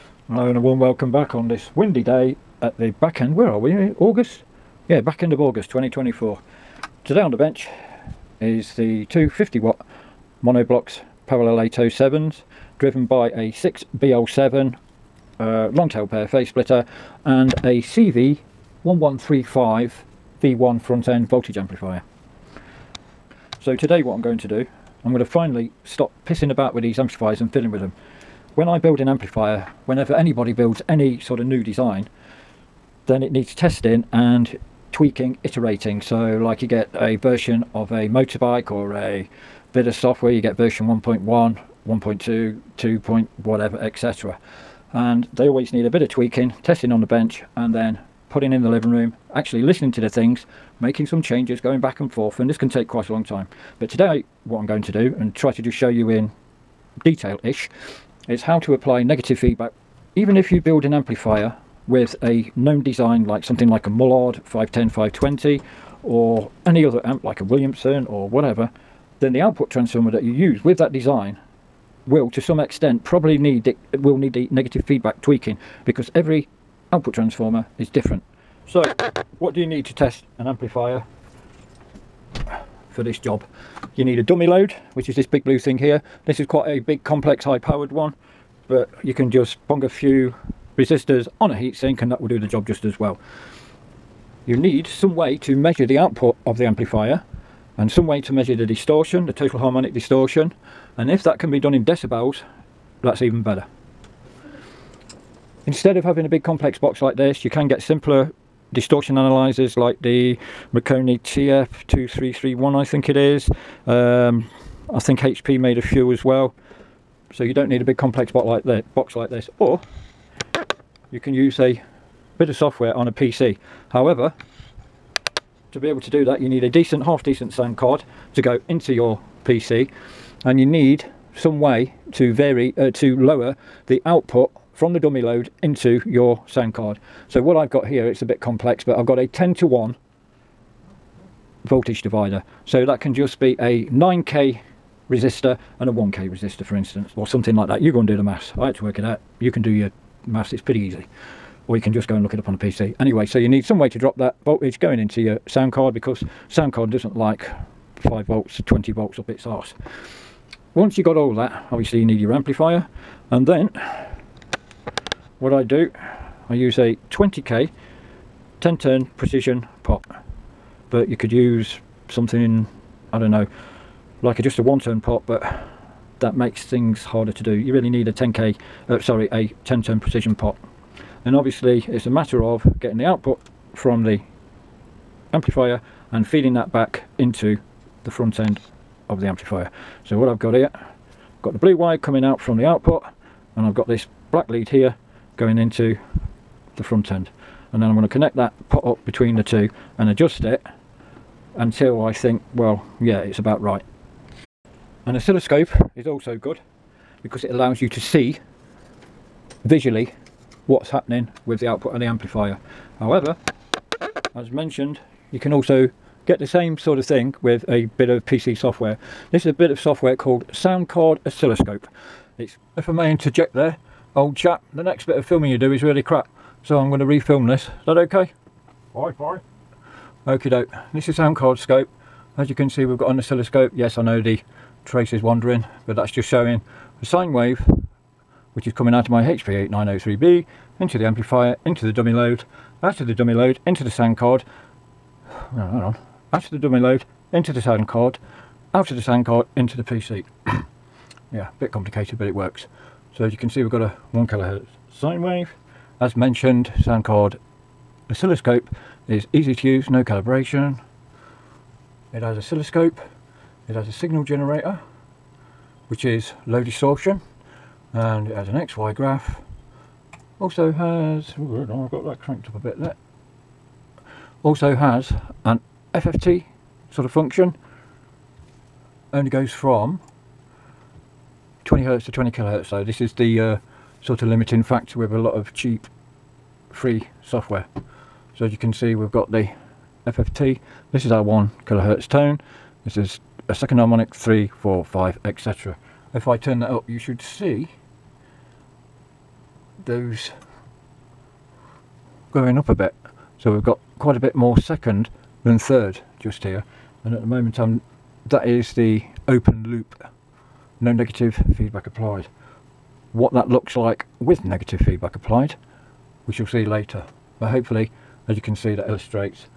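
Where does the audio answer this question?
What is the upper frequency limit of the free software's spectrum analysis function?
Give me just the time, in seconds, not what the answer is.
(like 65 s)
282 s.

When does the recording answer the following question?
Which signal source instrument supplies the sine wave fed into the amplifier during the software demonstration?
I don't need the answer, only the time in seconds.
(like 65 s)
239 s.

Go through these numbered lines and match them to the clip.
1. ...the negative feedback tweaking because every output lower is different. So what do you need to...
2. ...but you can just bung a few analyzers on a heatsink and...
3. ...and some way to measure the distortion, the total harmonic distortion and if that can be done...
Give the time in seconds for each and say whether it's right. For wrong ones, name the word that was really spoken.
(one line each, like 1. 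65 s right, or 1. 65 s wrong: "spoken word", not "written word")
1. 74 s wrong: "transformer", not "lower"
2. 88 s wrong: "resistors", not "analyzers"
3. 97 s right.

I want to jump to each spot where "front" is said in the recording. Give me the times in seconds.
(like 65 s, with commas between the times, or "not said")
20 s, 188 s, 196 s.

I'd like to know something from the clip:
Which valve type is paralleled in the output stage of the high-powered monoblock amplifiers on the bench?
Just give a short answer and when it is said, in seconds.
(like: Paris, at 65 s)
807, at 11 s.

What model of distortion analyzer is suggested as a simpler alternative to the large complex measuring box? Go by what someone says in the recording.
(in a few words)
Marconi TF2331.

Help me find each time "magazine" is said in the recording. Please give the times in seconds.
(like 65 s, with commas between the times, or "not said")
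not said.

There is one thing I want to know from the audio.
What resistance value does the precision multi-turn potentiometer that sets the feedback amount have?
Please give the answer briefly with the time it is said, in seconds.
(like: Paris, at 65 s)
20k, at 167 s.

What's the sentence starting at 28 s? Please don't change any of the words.
When I build an amplifier, whenever anybody builds any sort of new design, then it needs testing and tweaking, iterating.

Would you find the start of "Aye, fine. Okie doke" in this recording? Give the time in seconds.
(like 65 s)
228 s.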